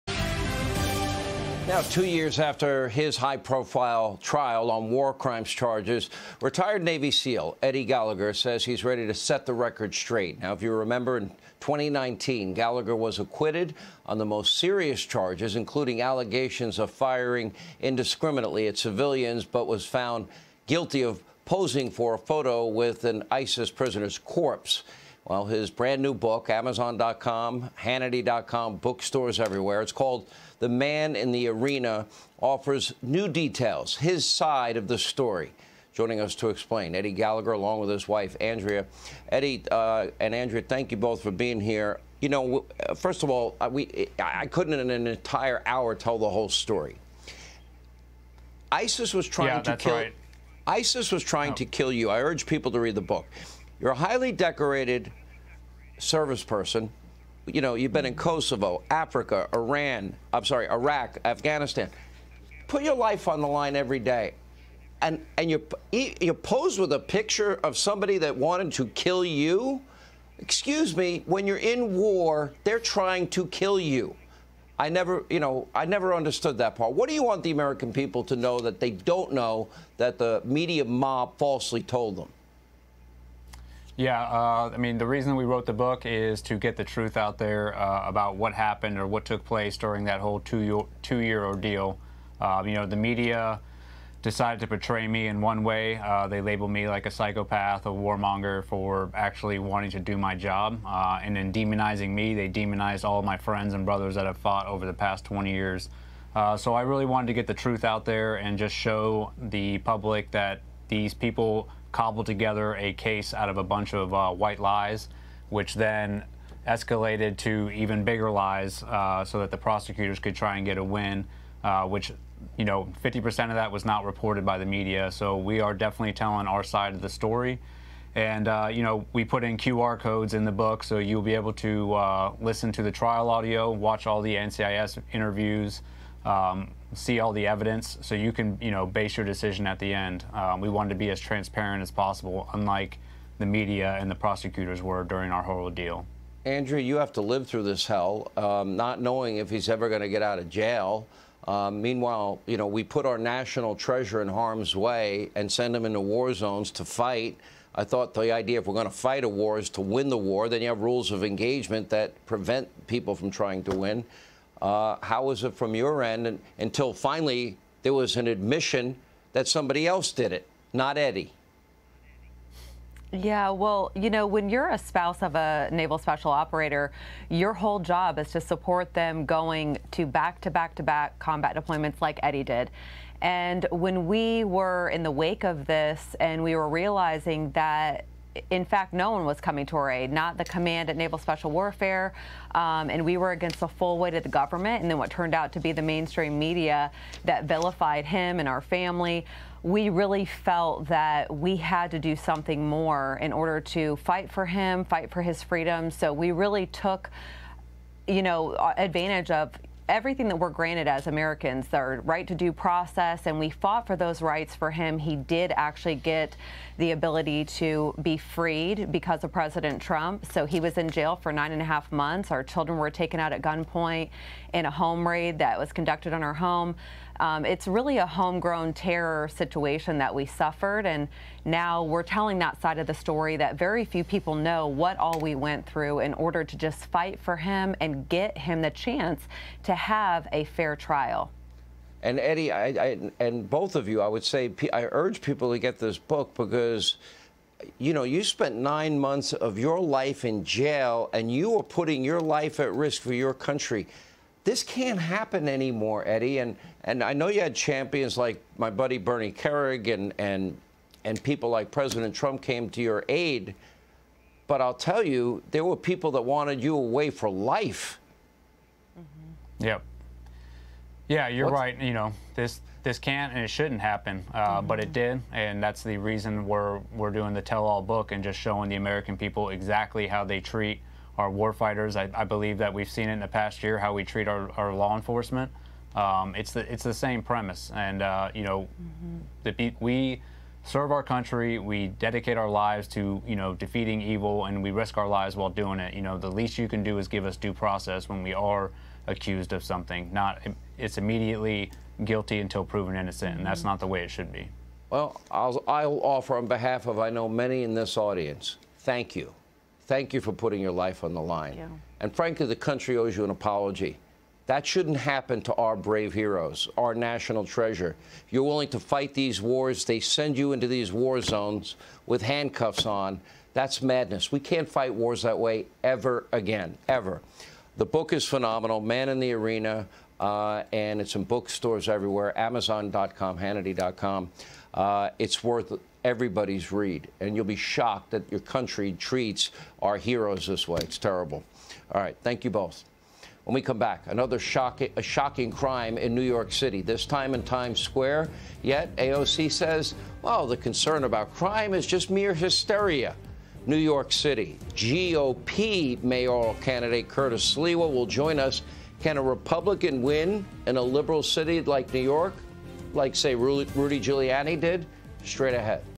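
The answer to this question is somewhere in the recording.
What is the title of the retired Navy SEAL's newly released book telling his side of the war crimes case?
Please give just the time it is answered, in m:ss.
0:30.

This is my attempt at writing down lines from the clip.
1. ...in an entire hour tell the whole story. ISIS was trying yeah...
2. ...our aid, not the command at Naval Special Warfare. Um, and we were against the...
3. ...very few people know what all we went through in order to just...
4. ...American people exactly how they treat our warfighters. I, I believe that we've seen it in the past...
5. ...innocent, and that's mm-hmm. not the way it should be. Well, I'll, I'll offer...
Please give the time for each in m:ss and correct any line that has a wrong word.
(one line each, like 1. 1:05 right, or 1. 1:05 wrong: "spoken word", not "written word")
1. 0:44 right
2. 3:09 right
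3. 3:53 right
4. 4:38 right
5. 5:02 right.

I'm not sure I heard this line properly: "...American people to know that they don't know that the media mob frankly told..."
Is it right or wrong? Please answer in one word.
wrong.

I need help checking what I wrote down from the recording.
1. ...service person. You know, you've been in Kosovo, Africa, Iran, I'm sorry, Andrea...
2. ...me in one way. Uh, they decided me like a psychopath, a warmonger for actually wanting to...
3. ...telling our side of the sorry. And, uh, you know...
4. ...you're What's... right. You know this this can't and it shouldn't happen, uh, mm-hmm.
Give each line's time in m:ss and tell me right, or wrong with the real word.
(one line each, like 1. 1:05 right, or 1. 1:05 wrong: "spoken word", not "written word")
1. 0:55 wrong: "Iraq", not "Andrea"
2. 1:35 wrong: "labeled", not "decided"
3. 2:06 wrong: "story", not "sorry"
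4. 4:31 right.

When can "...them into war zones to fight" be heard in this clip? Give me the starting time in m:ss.
2:35.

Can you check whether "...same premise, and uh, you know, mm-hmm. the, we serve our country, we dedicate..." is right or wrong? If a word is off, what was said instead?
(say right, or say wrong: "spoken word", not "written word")
right.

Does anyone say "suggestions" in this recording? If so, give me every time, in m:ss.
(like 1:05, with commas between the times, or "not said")
not said.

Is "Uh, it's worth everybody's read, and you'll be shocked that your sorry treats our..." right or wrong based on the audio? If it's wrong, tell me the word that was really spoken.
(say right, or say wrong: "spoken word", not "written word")
wrong: "country", not "sorry".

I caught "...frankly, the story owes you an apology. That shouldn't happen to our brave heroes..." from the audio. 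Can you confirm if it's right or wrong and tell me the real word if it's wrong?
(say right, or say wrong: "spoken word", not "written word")
wrong: "country", not "story".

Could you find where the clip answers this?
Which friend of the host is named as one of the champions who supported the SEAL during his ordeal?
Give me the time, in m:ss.
4:18.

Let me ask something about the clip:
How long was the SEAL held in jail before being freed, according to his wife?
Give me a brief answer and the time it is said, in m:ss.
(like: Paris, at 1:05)
9.5 months, at 3:41.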